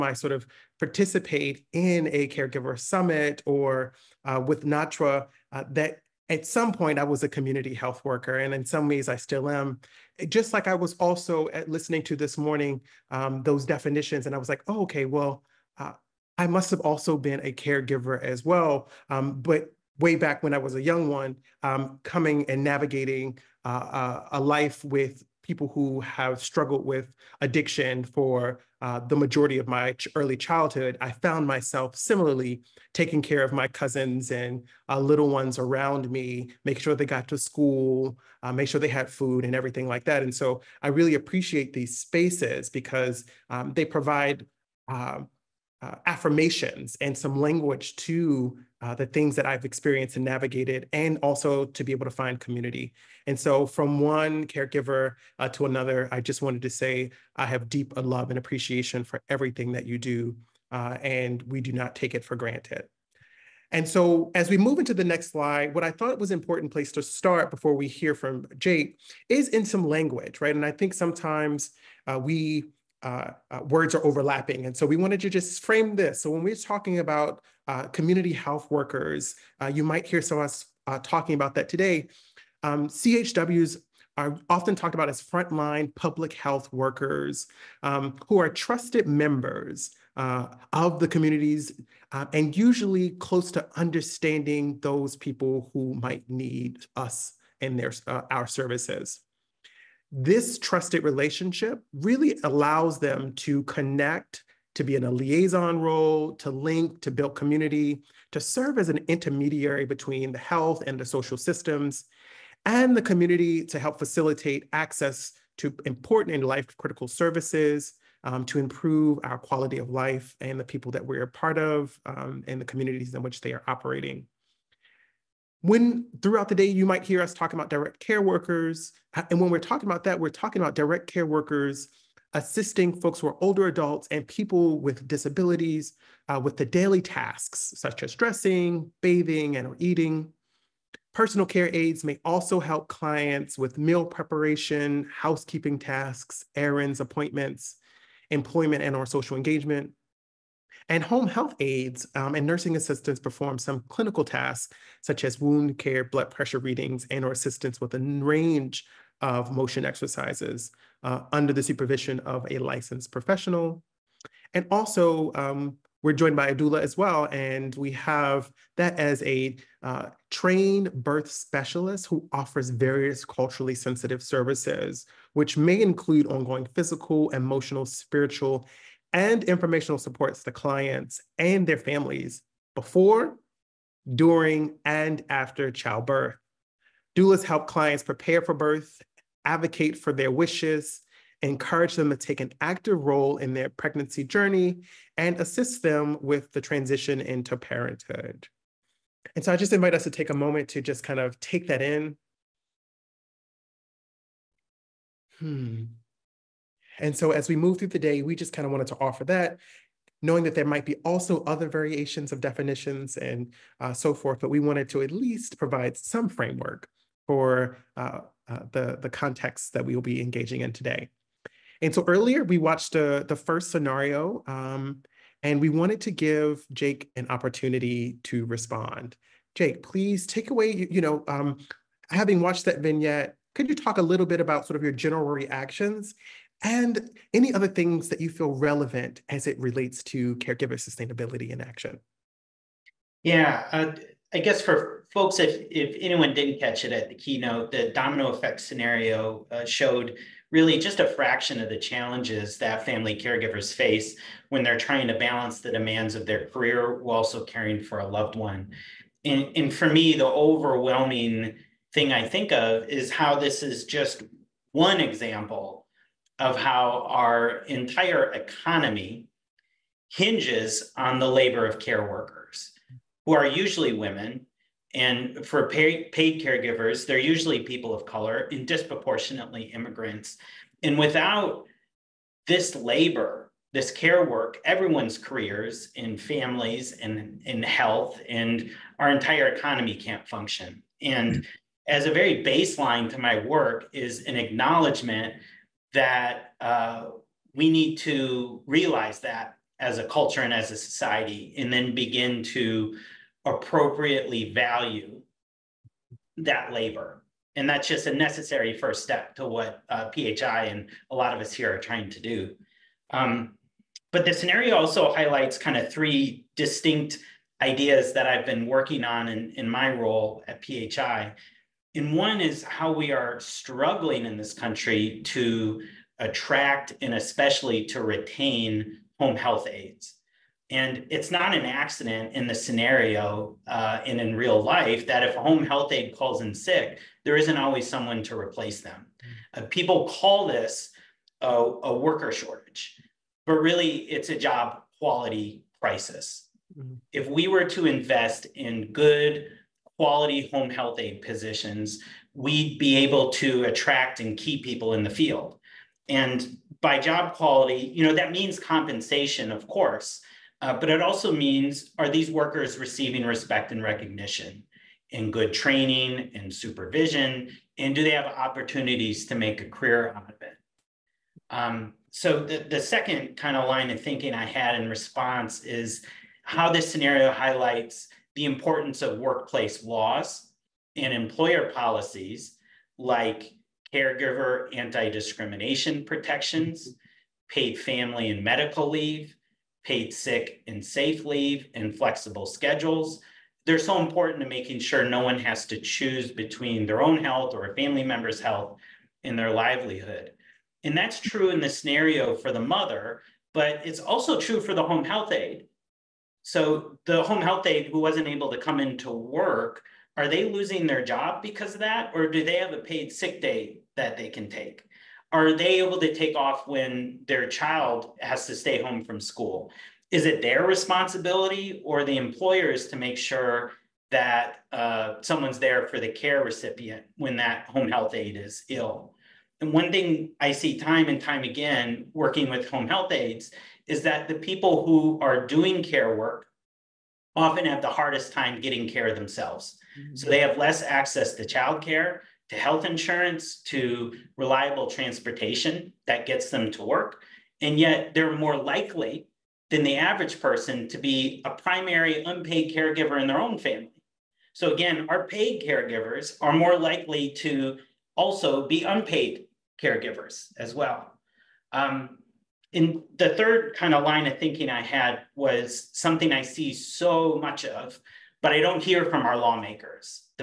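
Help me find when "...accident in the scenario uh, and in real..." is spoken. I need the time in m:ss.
5:31.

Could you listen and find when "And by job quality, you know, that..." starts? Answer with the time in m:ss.
5:56.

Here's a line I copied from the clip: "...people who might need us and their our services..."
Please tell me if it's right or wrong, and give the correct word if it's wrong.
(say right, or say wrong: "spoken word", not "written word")
right.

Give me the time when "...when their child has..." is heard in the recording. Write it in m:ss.
6:56.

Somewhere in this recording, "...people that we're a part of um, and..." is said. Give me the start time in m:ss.
2:00.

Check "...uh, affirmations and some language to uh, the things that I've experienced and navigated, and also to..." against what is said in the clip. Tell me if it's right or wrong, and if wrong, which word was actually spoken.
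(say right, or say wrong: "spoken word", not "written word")
right.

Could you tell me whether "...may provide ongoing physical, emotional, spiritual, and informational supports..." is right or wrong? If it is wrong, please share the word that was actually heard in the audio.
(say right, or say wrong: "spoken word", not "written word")
wrong: "include", not "provide".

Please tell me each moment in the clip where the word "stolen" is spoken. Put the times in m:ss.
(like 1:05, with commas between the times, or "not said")
not said.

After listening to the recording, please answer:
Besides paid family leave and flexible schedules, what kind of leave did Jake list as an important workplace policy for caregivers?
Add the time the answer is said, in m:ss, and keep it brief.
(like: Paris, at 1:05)
Paid sick and safe leave, at 6:29.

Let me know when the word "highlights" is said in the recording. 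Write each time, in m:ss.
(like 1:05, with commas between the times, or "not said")
5:15, 6:17.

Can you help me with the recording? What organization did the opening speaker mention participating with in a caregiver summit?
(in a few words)
NATRA.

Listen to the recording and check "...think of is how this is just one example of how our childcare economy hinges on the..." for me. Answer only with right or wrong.
wrong.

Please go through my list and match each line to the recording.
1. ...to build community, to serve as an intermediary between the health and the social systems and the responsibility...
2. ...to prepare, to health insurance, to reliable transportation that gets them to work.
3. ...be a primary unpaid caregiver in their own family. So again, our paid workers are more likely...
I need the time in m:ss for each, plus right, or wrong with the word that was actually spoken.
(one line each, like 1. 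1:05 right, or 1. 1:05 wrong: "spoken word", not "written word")
1. 1:47 wrong: "community", not "responsibility"
2. 7:21 wrong: "childcare", not "prepare"
3. 7:30 wrong: "caregivers", not "workers".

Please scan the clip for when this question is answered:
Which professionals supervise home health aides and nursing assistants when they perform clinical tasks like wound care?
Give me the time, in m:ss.
2:42.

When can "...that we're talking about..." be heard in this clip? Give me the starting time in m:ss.
2:10.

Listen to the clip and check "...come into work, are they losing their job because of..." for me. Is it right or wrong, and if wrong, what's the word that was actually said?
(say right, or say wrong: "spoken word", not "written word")
right.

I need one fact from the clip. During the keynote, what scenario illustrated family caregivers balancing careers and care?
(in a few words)
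Domino effect.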